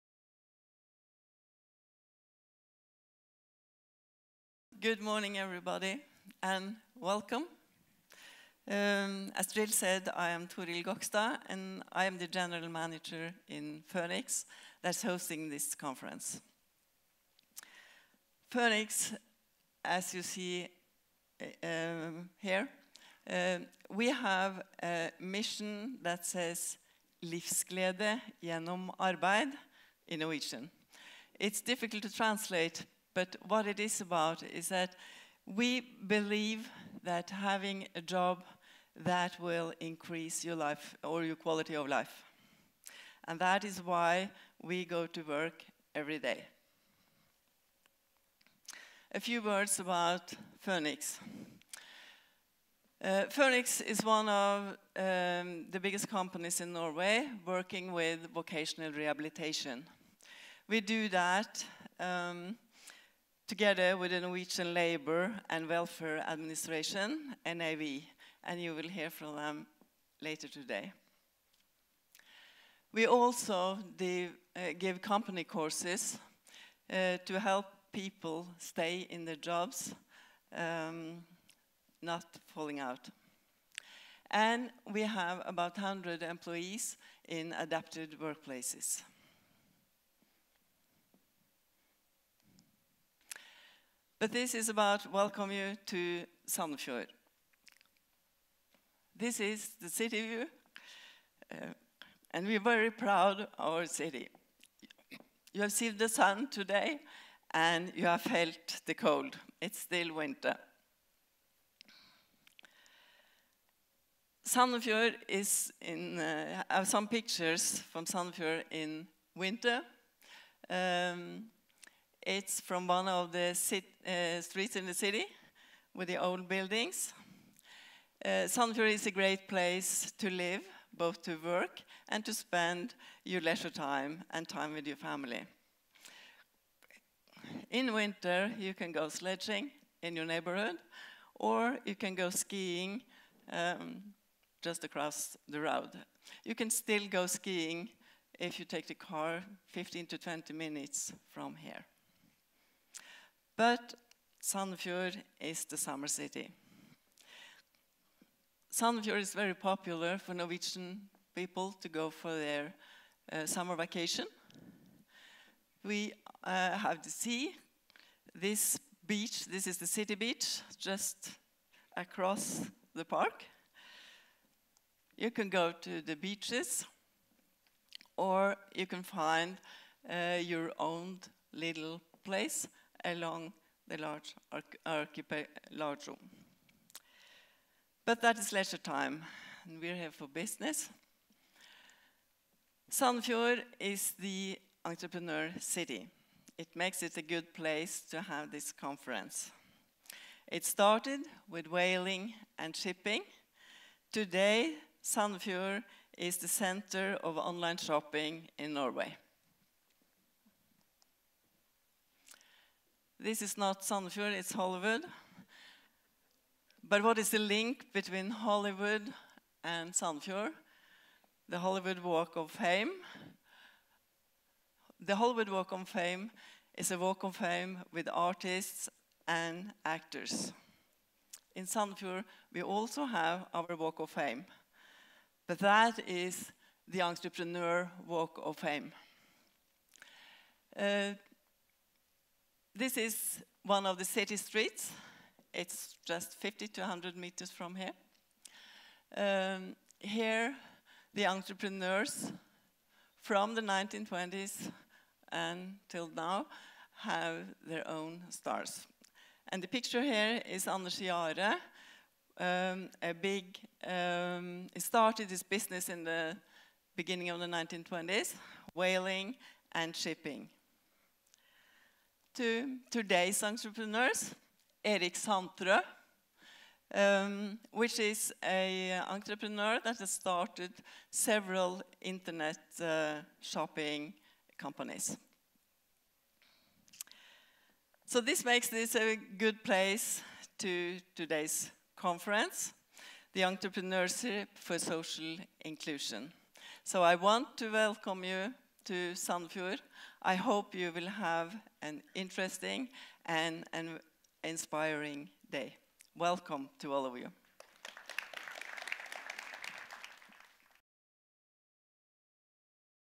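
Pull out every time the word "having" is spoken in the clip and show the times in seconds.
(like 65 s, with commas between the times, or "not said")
37 s.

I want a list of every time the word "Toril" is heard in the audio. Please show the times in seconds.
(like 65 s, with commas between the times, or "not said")
10 s.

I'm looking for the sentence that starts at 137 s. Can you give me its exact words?
In winter, you can go sledging in your neighborhood, or you can go skiing um, just across the road.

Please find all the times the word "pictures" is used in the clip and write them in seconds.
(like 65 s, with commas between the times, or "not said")
117 s, 259 s.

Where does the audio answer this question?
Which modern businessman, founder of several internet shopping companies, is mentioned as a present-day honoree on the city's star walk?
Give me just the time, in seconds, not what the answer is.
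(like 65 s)
274 s.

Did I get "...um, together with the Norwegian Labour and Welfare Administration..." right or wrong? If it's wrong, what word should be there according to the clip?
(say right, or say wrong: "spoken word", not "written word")
right.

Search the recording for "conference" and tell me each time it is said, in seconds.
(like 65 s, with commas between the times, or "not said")
15 s, 198 s, 291 s.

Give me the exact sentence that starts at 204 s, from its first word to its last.
Today, Sandefjord is the center of online shopping in Norway.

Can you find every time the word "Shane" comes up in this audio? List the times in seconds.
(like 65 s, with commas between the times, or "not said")
not said.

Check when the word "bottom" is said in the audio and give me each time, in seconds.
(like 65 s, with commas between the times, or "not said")
not said.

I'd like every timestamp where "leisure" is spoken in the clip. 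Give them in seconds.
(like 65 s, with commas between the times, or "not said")
133 s, 188 s.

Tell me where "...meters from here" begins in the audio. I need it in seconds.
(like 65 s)
247 s.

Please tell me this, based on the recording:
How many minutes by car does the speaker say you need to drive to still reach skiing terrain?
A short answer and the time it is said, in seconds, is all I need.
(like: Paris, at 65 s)
15 to 20 minutes, at 149 s.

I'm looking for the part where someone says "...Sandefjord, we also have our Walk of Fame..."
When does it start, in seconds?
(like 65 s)
231 s.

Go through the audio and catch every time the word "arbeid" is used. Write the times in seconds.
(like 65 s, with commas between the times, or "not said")
28 s.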